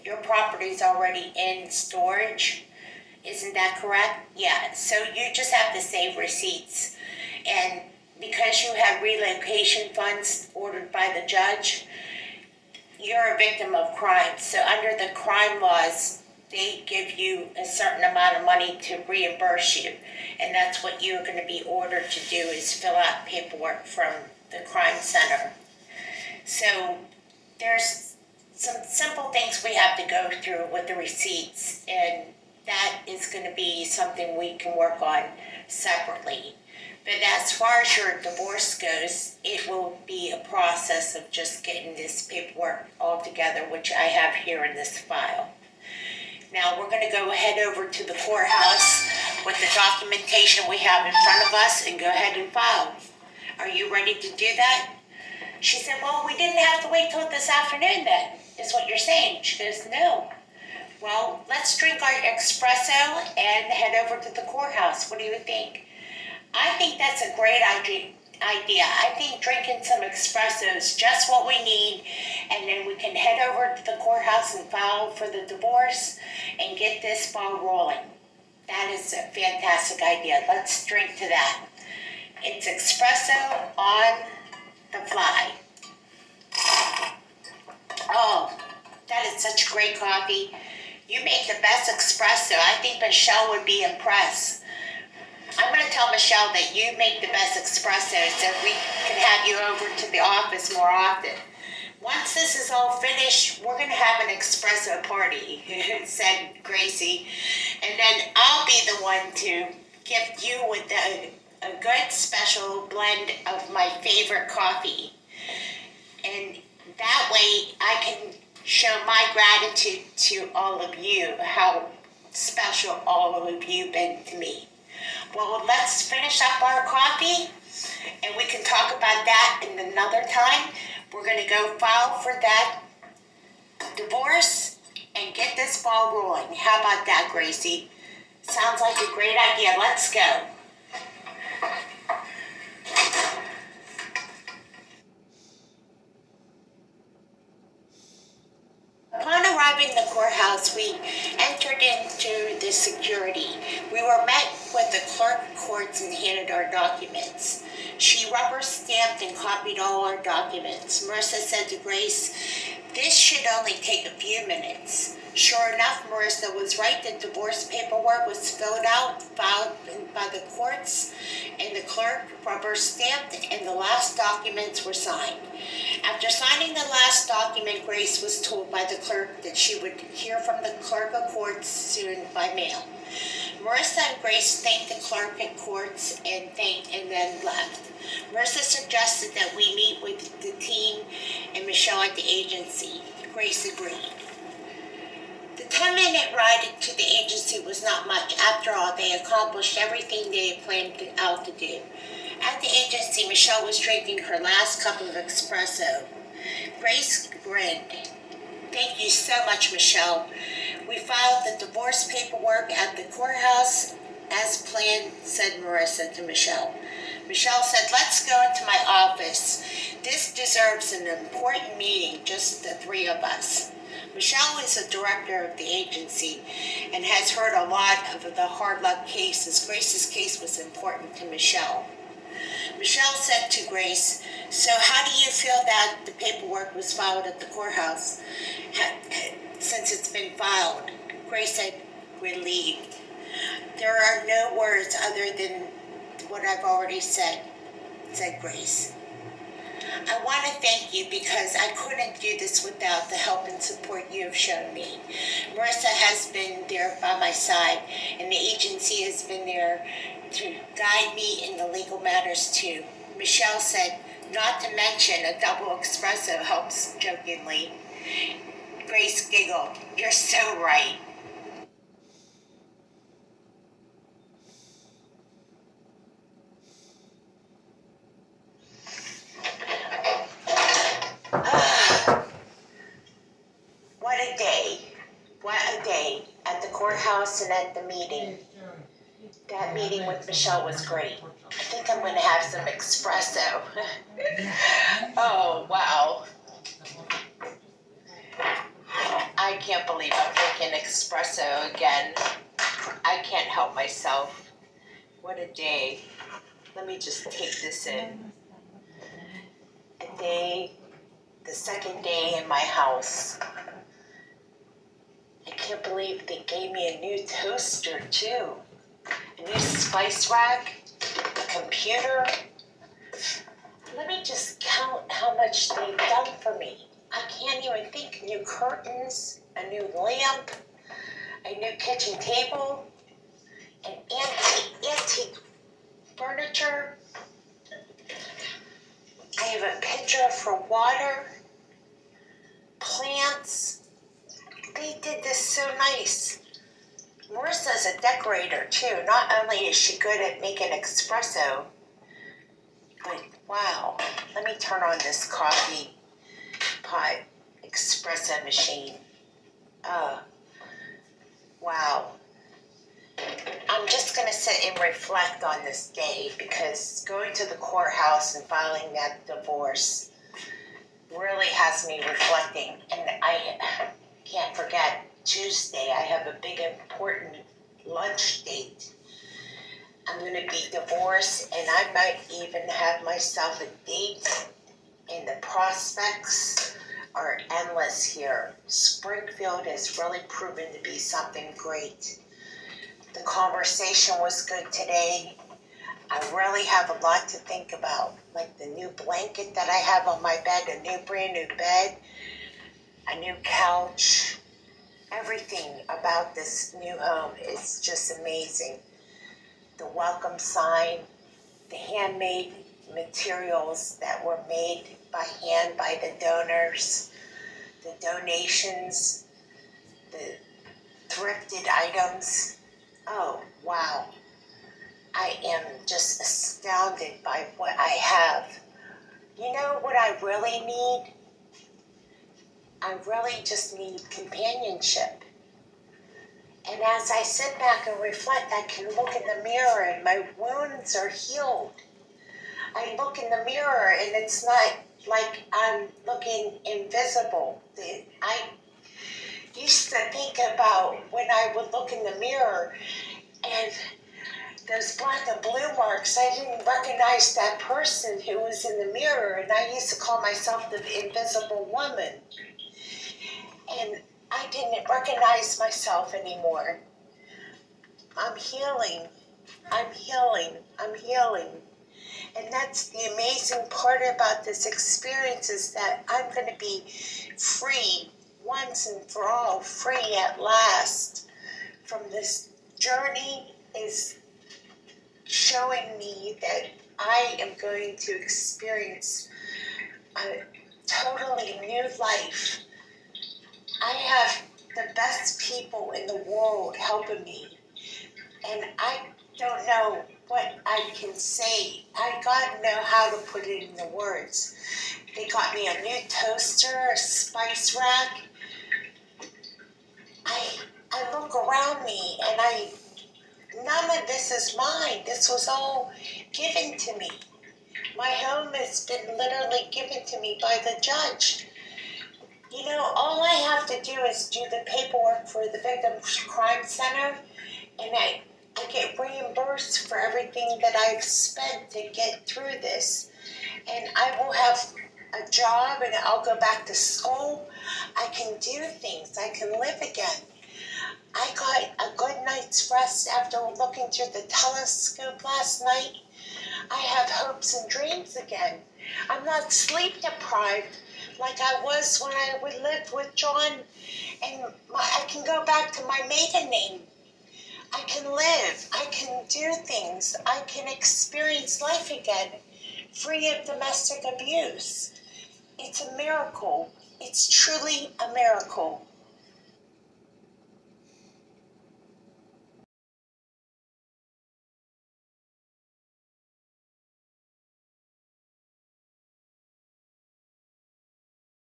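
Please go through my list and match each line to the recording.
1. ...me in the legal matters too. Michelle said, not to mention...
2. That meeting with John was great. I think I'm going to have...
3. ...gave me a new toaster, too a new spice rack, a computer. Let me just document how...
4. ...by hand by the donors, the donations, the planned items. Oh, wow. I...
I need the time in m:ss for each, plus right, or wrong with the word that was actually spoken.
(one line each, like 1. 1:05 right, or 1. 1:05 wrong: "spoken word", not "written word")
1. 4:21 right
2. 4:49 wrong: "Michelle", not "John"
3. 5:16 wrong: "count", not "document"
4. 6:55 wrong: "thrifted", not "planned".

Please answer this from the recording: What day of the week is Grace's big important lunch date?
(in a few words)
Tuesday.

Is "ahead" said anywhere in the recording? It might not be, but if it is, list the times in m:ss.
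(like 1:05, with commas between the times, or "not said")
0:52.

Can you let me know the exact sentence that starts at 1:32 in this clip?
I think Michelle would be impressed.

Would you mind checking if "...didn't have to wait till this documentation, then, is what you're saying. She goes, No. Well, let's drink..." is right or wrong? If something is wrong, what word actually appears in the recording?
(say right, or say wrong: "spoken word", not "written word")
wrong: "afternoon", not "documentation".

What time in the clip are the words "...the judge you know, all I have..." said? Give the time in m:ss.
8:40.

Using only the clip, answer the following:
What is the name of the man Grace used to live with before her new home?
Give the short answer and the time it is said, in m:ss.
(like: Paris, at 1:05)
John, at 9:13.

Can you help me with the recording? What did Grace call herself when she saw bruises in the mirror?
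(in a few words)
The invisible woman.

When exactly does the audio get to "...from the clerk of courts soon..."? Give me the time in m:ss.
3:00.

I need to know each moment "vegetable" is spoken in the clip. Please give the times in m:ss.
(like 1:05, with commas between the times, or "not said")
not said.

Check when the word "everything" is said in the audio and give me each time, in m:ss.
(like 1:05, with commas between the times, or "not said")
3:19, 6:45, 8:49.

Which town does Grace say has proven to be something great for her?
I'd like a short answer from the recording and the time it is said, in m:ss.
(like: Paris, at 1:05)
Springfield, at 6:28.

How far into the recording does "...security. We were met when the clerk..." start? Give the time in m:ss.
2:32.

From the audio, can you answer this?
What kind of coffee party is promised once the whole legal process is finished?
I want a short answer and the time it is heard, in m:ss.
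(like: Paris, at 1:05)
An espresso party, at 1:44.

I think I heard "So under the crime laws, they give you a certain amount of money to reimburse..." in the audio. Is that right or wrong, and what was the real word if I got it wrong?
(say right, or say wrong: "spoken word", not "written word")
right.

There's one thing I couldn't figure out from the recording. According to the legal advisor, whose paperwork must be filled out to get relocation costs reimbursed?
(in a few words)
The crime center.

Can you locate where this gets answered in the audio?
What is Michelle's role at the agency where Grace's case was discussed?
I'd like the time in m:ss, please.
3:44.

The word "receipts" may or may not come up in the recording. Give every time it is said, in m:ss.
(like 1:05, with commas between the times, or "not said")
0:06, 0:30.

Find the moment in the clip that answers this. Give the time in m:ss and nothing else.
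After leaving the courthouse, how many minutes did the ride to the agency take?
3:15.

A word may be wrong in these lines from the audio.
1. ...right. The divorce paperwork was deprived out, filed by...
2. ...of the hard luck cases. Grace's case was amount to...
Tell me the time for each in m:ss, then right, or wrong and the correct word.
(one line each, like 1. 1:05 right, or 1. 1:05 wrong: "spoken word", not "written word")
1. 2:46 wrong: "filled", not "deprived"
2. 3:48 wrong: "important", not "amount".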